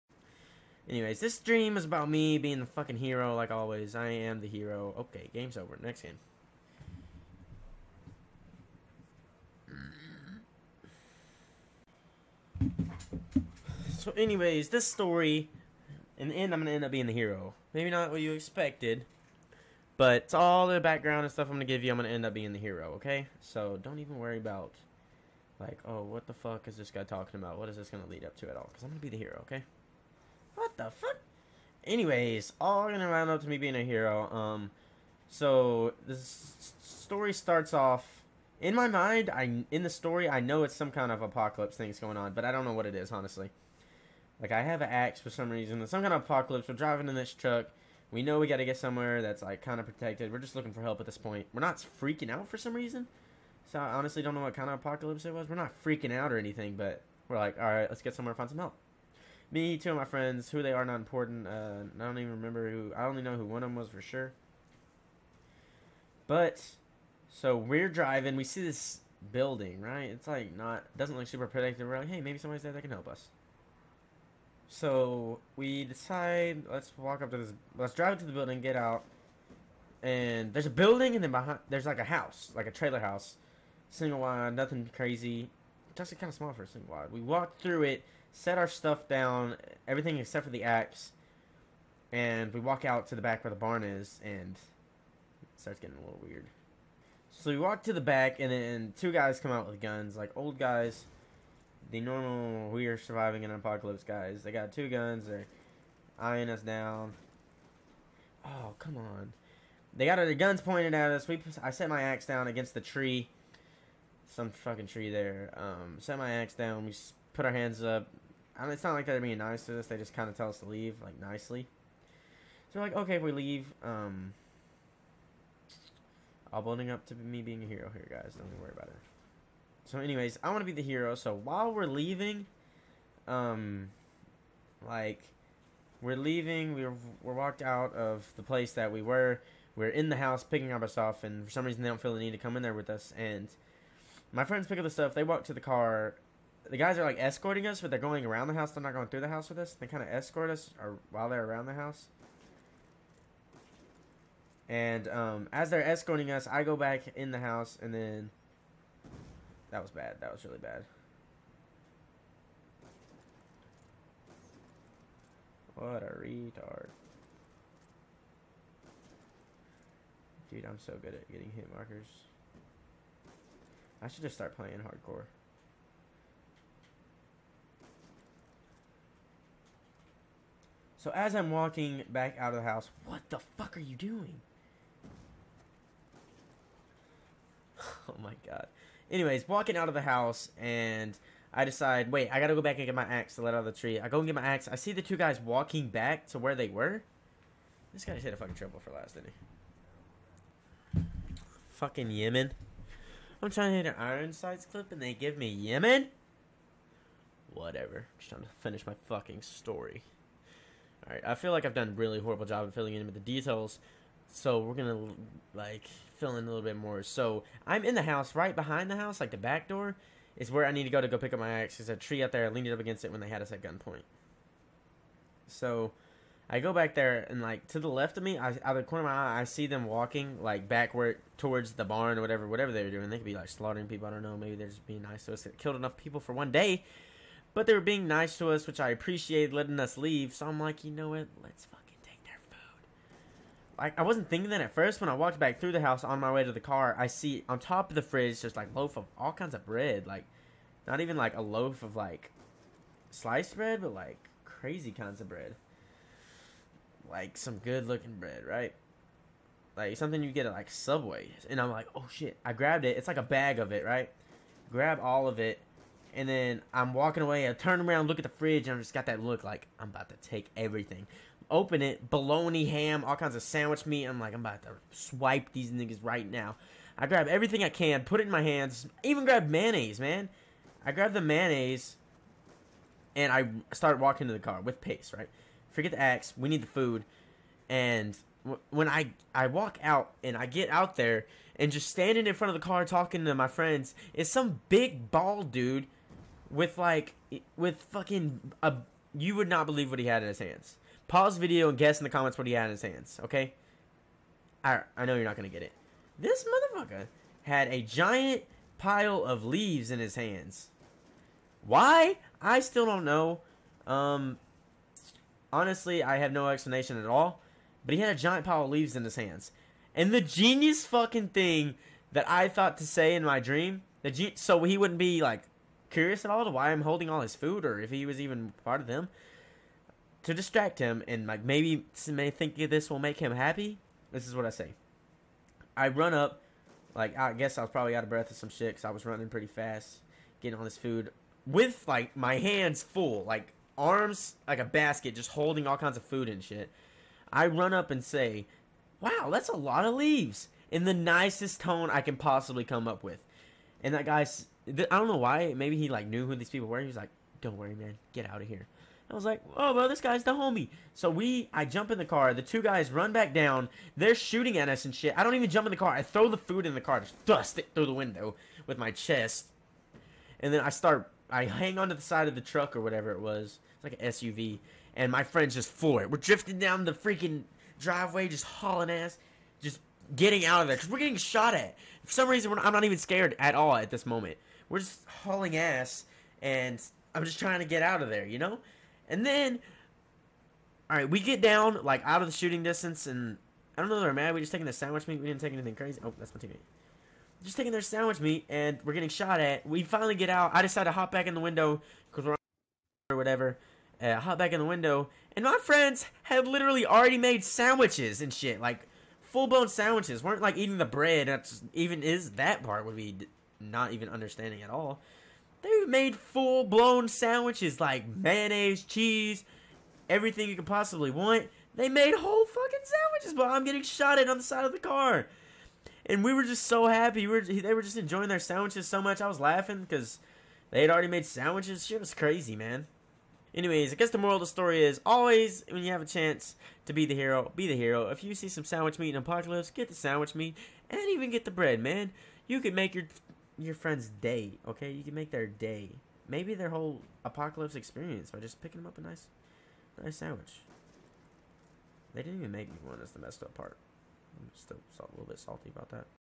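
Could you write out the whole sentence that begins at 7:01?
They made whole fucking sandwiches, but I'm getting shot at on the side of the car and we were just so happy.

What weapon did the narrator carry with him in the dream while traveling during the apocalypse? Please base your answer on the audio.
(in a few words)
An axe.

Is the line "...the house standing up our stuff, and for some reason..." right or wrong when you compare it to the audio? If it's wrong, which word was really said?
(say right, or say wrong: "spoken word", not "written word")
wrong: "picking", not "standing".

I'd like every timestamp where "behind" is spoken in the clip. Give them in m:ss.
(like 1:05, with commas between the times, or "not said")
1:21, 3:38.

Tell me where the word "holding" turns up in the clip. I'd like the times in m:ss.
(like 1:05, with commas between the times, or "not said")
5:26, 5:45.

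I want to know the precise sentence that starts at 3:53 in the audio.
They could be like slaughtering people.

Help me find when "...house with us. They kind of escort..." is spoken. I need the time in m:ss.
2:29.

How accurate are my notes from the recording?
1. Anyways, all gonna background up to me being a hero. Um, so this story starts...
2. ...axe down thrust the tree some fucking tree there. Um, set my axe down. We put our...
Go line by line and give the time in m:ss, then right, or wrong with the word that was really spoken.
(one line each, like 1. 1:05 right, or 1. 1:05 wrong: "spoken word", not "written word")
1. 0:31 wrong: "round", not "background"
2. 1:52 wrong: "against", not "thrust".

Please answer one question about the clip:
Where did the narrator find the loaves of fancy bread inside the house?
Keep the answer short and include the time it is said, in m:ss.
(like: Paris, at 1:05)
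On top of the fridge, at 4:07.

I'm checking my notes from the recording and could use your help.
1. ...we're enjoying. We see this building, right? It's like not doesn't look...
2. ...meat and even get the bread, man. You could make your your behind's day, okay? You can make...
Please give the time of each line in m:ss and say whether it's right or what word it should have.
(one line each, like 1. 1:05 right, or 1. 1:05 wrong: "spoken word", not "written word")
1. 1:07 wrong: "driving", not "enjoying"
2. 7:20 wrong: "friend", not "behind".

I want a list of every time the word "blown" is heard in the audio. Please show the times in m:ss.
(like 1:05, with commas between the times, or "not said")
6:49, 6:56.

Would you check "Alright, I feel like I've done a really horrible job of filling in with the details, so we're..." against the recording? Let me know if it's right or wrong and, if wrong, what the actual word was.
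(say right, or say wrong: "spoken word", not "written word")
right.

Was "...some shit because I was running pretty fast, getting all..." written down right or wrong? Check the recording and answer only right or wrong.
right.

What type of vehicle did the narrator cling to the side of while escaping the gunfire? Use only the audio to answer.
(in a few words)
An SUV.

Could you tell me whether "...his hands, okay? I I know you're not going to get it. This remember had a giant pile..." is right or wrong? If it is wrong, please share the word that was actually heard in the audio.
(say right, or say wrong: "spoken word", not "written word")
wrong: "motherfucker", not "remember".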